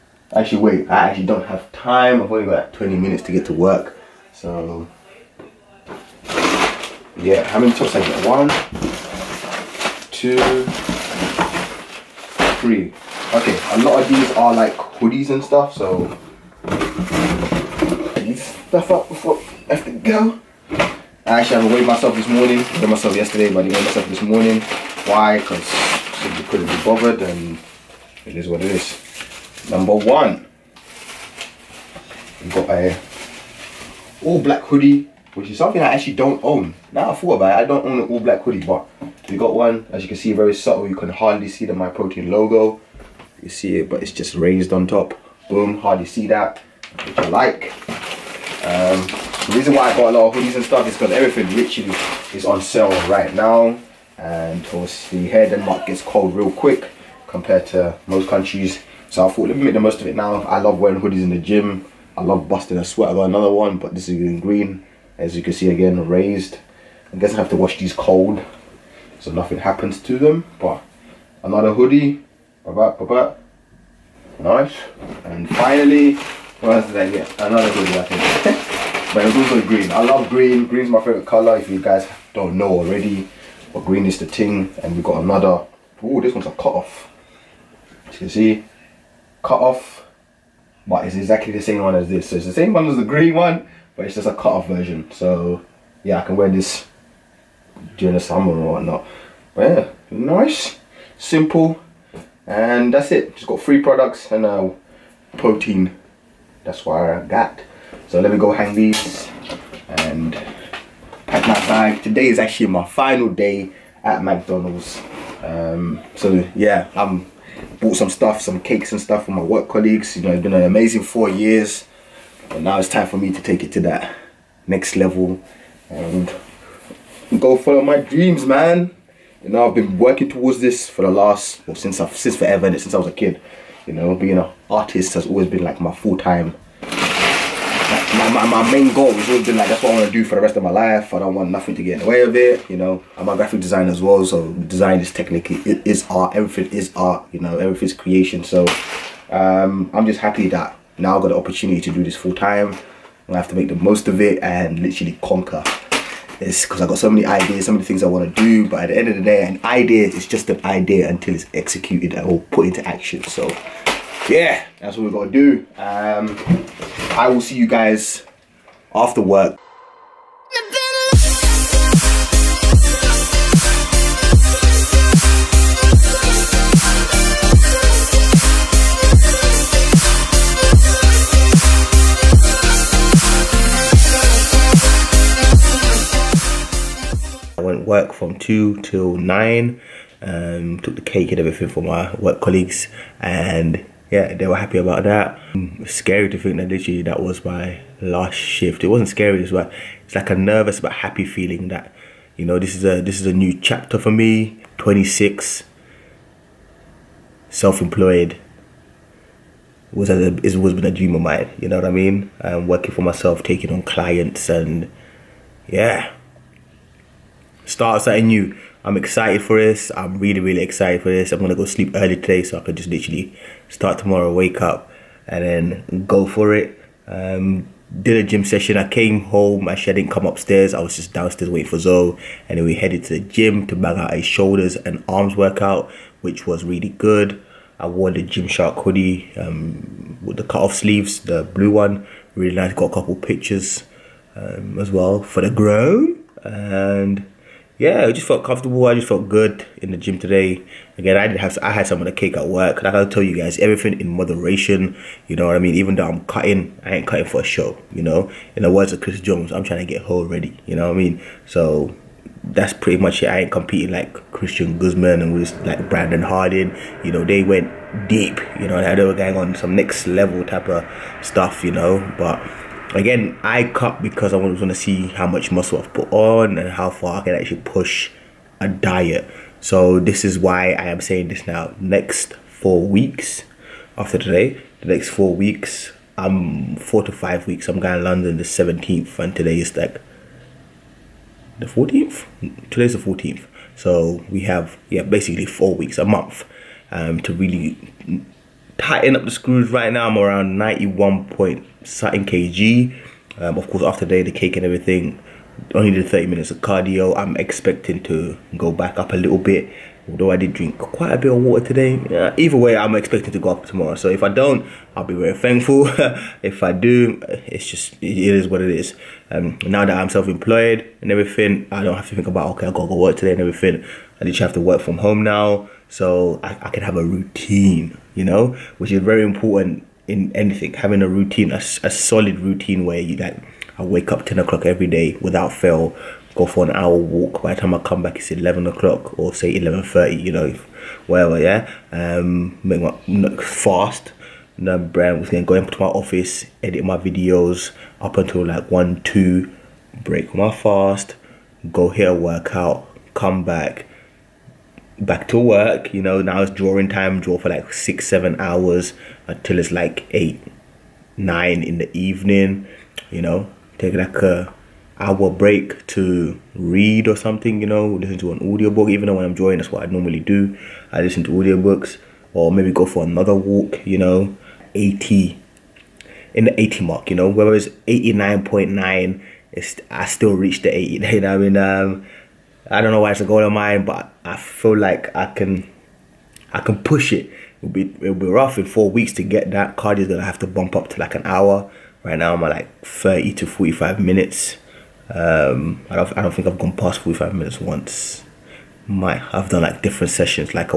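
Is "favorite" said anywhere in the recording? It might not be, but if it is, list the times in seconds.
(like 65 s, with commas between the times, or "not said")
80 s.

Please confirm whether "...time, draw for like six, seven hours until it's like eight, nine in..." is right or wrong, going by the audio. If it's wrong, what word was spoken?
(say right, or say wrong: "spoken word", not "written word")
right.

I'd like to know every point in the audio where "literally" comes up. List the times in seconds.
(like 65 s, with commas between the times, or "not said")
51 s, 154 s, 196 s, 222 s, 324 s.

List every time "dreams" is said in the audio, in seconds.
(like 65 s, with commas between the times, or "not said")
127 s, 210 s.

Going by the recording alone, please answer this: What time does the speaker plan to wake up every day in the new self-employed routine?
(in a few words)
10 o'clock.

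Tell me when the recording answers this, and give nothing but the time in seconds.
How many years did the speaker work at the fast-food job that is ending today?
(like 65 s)
121 s.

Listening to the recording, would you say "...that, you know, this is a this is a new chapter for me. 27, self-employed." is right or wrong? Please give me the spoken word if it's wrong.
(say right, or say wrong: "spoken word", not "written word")
wrong: "26", not "27".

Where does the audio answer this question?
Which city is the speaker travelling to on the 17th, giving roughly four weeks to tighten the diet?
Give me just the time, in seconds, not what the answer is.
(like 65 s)
288 s.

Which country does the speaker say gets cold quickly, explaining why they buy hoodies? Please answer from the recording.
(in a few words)
Denmark.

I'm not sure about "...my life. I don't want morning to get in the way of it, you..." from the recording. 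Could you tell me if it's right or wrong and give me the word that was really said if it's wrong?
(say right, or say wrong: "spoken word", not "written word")
wrong: "nothing", not "morning".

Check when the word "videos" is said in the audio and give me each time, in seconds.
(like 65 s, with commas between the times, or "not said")
346 s.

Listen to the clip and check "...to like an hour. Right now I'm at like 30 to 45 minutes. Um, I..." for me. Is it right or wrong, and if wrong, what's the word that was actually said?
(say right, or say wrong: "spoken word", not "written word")
right.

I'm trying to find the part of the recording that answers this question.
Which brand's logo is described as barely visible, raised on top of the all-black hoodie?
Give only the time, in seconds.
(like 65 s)
41 s.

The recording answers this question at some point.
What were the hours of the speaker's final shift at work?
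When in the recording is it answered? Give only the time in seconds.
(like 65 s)
188 s.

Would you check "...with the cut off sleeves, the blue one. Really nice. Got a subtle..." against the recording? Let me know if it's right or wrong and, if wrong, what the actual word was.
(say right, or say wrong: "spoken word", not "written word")
wrong: "couple", not "subtle".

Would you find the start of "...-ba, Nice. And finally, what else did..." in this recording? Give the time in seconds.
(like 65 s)
72 s.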